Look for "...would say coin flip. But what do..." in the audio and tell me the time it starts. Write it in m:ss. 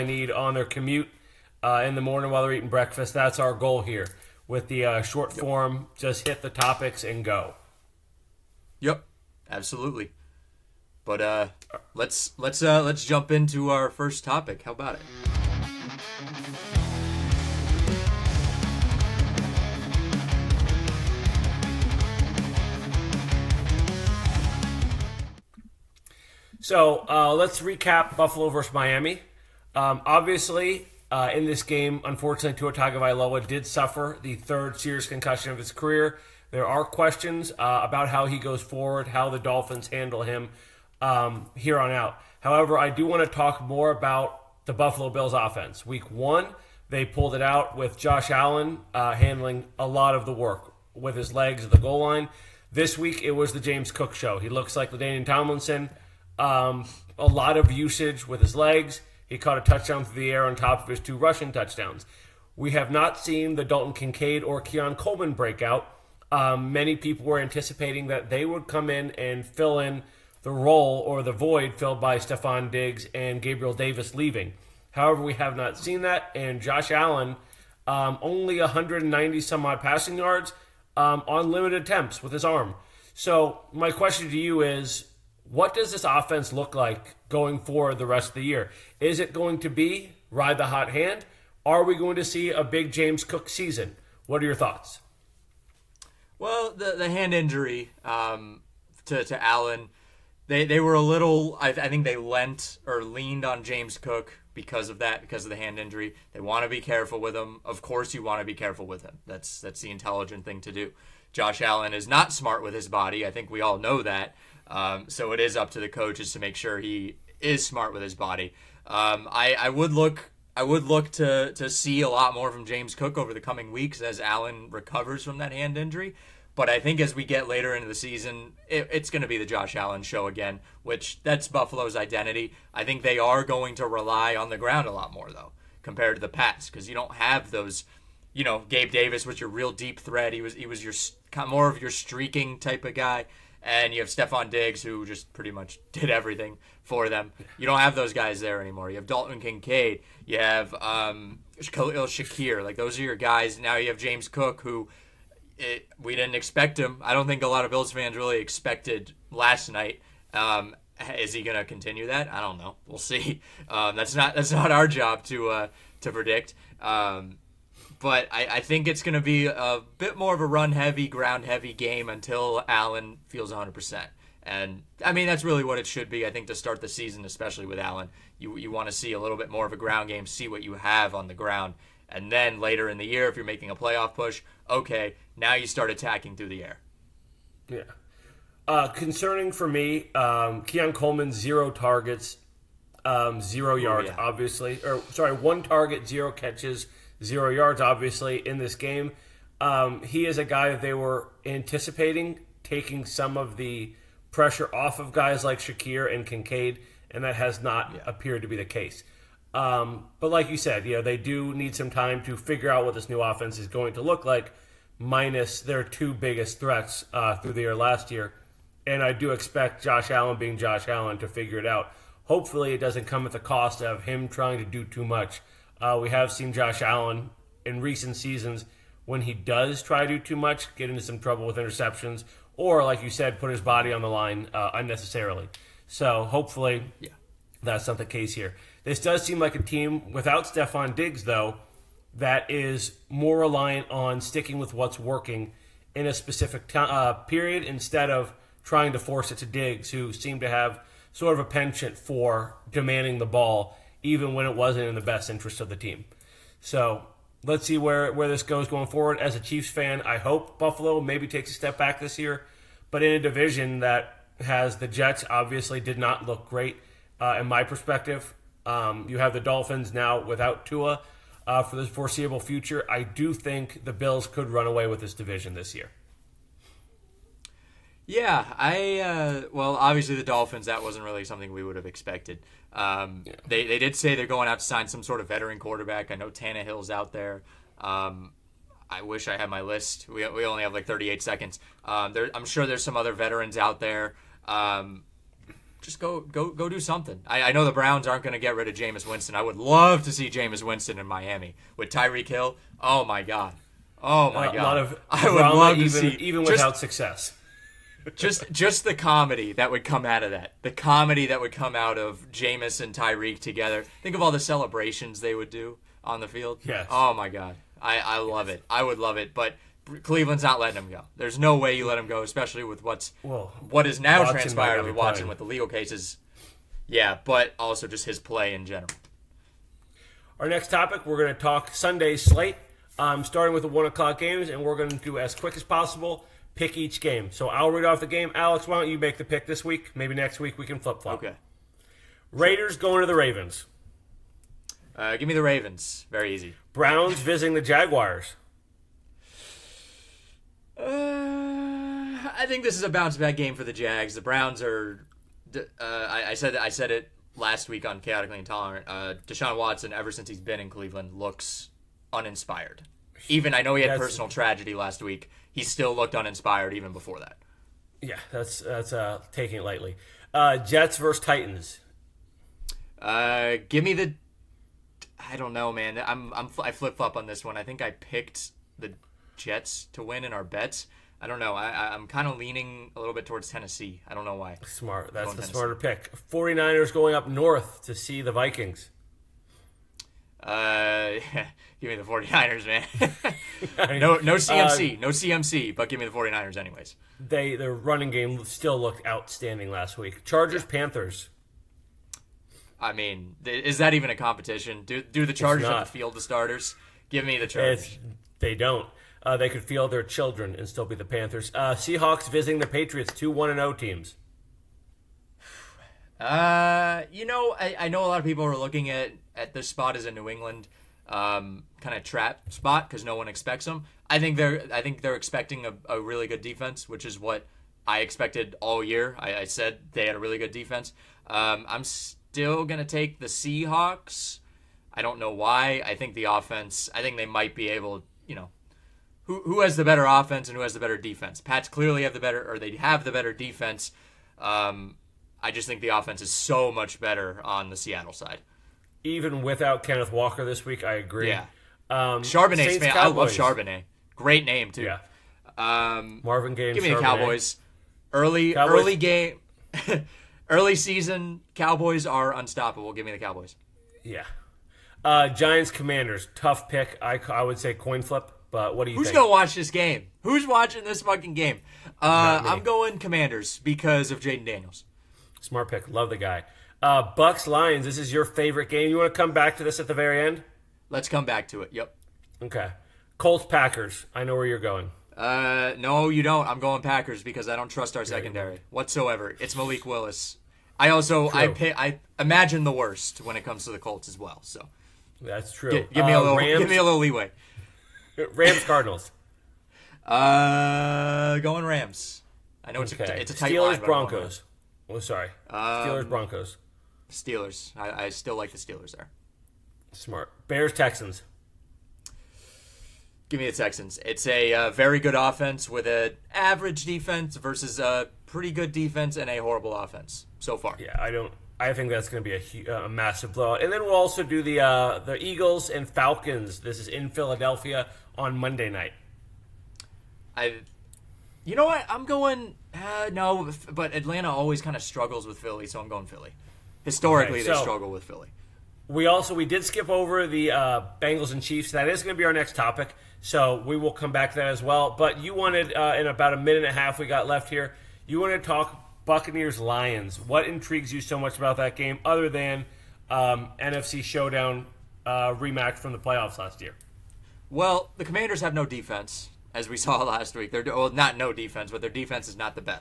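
7:47.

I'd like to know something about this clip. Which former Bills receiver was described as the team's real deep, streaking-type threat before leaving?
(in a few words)
Gabe Davis.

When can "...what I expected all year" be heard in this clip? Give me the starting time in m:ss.
7:07.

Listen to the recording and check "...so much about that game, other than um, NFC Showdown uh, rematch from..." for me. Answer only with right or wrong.
right.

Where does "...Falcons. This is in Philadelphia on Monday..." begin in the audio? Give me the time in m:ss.
8:45.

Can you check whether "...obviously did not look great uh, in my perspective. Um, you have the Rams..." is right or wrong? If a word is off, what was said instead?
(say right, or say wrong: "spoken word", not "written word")
wrong: "Dolphins", not "Rams".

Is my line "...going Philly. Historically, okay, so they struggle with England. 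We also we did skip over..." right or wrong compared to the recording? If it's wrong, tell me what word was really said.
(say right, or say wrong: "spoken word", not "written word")
wrong: "Philly", not "England".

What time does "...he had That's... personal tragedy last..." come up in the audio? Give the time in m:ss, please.
6:03.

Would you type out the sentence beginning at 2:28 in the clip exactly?
You have Dalton Kincaid, you have um, Khalil Shakir.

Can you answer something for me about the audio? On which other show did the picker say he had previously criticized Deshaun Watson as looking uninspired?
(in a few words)
Chaotically Intolerant.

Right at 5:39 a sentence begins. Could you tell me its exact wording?
Maybe next week we can flip flop.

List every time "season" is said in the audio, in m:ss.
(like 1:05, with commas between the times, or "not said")
1:33, 2:07, 2:56, 3:48, 7:40.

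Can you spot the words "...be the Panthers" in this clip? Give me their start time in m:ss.
6:50.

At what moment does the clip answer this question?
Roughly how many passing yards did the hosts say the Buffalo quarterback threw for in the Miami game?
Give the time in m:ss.
1:18.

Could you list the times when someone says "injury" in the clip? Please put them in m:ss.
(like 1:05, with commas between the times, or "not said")
1:37, 1:45, 2:05.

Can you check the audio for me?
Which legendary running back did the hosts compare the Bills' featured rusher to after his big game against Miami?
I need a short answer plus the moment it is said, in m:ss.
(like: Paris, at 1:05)
LaDainian Tomlinson, at 0:54.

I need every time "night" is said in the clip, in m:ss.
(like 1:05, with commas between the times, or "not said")
2:39, 8:48.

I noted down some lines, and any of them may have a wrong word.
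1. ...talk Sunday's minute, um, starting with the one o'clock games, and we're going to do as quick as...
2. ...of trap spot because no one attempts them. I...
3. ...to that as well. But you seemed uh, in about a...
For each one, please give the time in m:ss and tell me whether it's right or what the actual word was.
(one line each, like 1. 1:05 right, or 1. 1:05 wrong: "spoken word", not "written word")
1. 5:31 wrong: "slate", not "minute"
2. 7:01 wrong: "expects", not "attempts"
3. 9:04 wrong: "wanted", not "seemed".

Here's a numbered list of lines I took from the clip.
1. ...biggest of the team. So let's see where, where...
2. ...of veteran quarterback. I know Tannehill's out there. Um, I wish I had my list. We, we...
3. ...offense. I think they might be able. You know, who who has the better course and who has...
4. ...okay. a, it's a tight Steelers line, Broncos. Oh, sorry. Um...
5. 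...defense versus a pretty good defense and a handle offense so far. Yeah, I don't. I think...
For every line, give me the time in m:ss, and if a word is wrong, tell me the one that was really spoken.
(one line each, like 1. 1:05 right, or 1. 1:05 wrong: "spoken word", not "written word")
1. 4:15 wrong: "interest", not "biggest"
2. 4:45 right
3. 7:16 wrong: "offense", not "course"
4. 8:22 right
5. 8:36 wrong: "horrible", not "handle".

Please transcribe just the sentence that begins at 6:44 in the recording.
Do do the Chargers have to field the starters?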